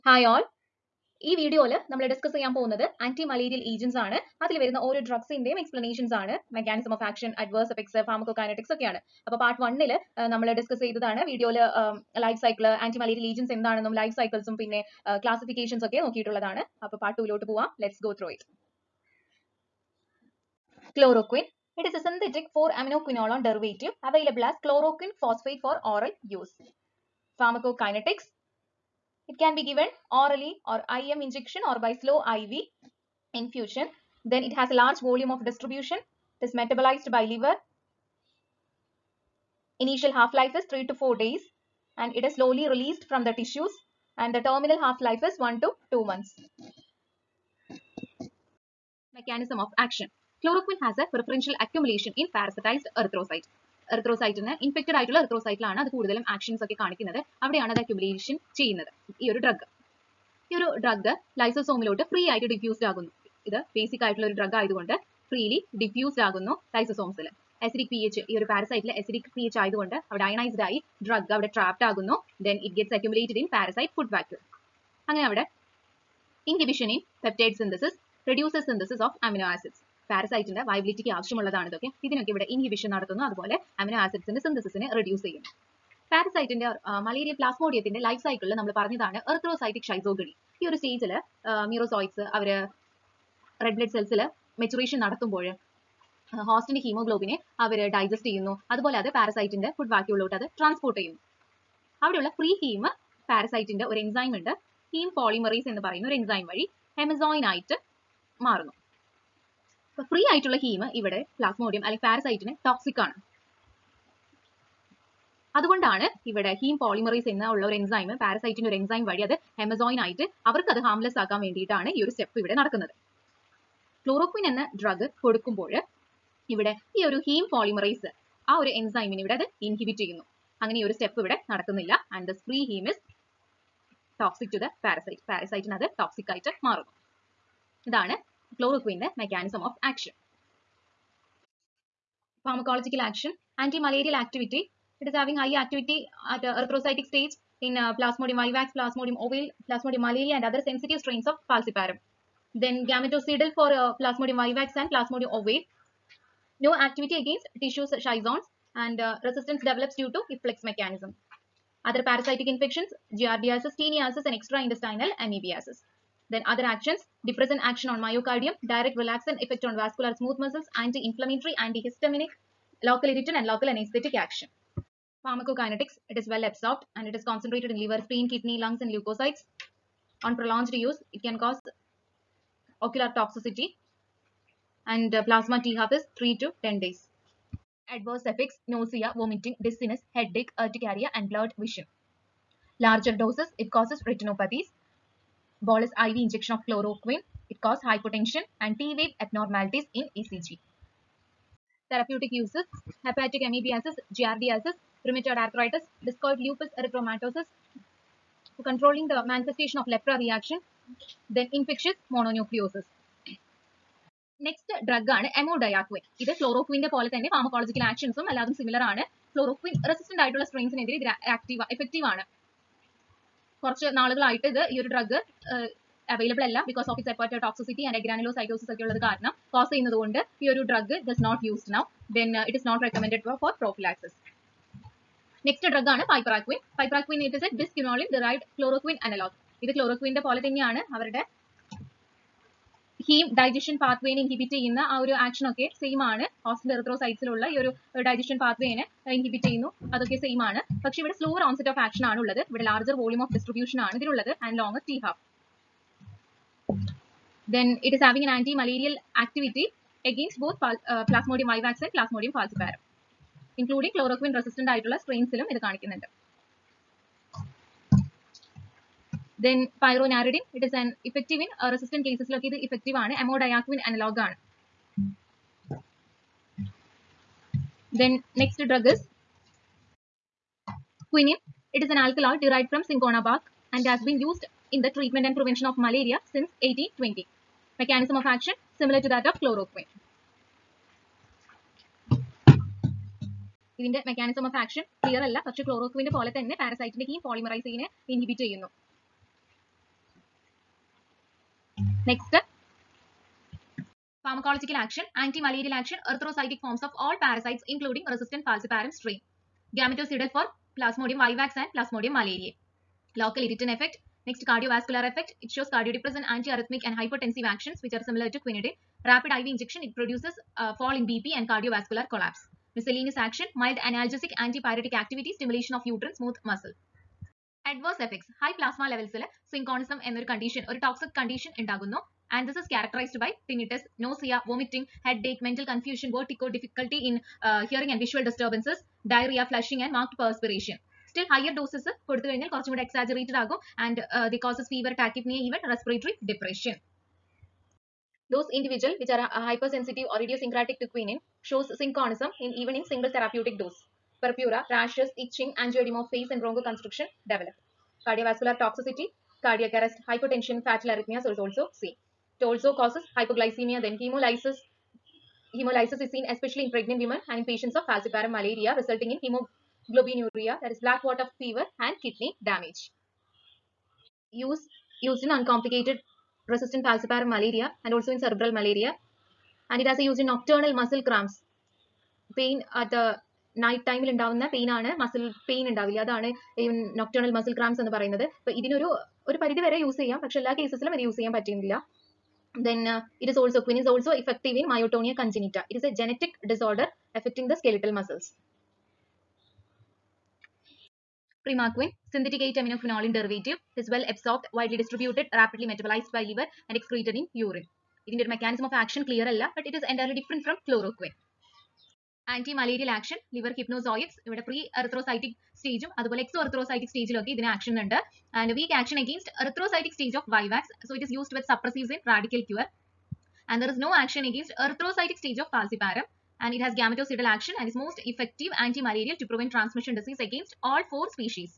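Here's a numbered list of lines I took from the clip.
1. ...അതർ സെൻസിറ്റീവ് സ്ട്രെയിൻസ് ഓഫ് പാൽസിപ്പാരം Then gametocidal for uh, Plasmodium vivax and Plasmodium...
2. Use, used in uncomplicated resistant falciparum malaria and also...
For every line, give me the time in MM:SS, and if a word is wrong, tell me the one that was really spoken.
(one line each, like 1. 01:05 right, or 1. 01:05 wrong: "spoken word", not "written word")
1. 02:30 right
2. 06:14 right.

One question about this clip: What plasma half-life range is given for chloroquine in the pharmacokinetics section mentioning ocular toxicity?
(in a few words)
3 to 10 days.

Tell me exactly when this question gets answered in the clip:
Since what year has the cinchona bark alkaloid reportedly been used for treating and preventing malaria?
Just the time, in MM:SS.
04:46.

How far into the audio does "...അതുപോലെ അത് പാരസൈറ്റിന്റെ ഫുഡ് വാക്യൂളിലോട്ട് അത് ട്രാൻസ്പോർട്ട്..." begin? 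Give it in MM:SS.
01:38.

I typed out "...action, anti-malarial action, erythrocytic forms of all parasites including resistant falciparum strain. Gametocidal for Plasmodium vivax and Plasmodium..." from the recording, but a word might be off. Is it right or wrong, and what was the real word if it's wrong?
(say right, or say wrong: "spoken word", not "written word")
right.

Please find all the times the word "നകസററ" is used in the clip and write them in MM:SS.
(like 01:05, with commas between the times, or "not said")
03:34, 05:02.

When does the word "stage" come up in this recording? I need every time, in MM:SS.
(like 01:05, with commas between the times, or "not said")
06:59, 07:05.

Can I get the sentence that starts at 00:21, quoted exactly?
It is a synthetic 4-aminoquinolone derivative available as chloroquine phosphate for oral use.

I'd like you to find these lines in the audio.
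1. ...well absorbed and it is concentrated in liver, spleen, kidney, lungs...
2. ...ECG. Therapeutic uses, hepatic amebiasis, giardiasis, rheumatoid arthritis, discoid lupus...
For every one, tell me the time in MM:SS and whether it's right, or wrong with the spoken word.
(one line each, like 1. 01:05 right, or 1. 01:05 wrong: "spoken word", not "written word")
1. 02:56 right
2. 03:20 right.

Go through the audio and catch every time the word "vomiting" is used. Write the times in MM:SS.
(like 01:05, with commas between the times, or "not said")
03:09, 05:34.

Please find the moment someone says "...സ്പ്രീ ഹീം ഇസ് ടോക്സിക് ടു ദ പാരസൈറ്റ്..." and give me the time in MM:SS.
02:12.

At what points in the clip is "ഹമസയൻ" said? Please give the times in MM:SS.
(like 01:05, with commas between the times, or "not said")
01:46, 01:59.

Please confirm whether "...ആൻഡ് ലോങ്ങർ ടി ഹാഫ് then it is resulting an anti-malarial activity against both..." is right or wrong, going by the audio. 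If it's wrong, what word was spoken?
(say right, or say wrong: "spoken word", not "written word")
wrong: "having", not "resulting".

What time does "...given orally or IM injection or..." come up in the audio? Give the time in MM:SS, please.
00:29.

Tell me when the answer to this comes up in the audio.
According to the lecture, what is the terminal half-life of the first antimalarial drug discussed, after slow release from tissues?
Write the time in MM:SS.
00:45.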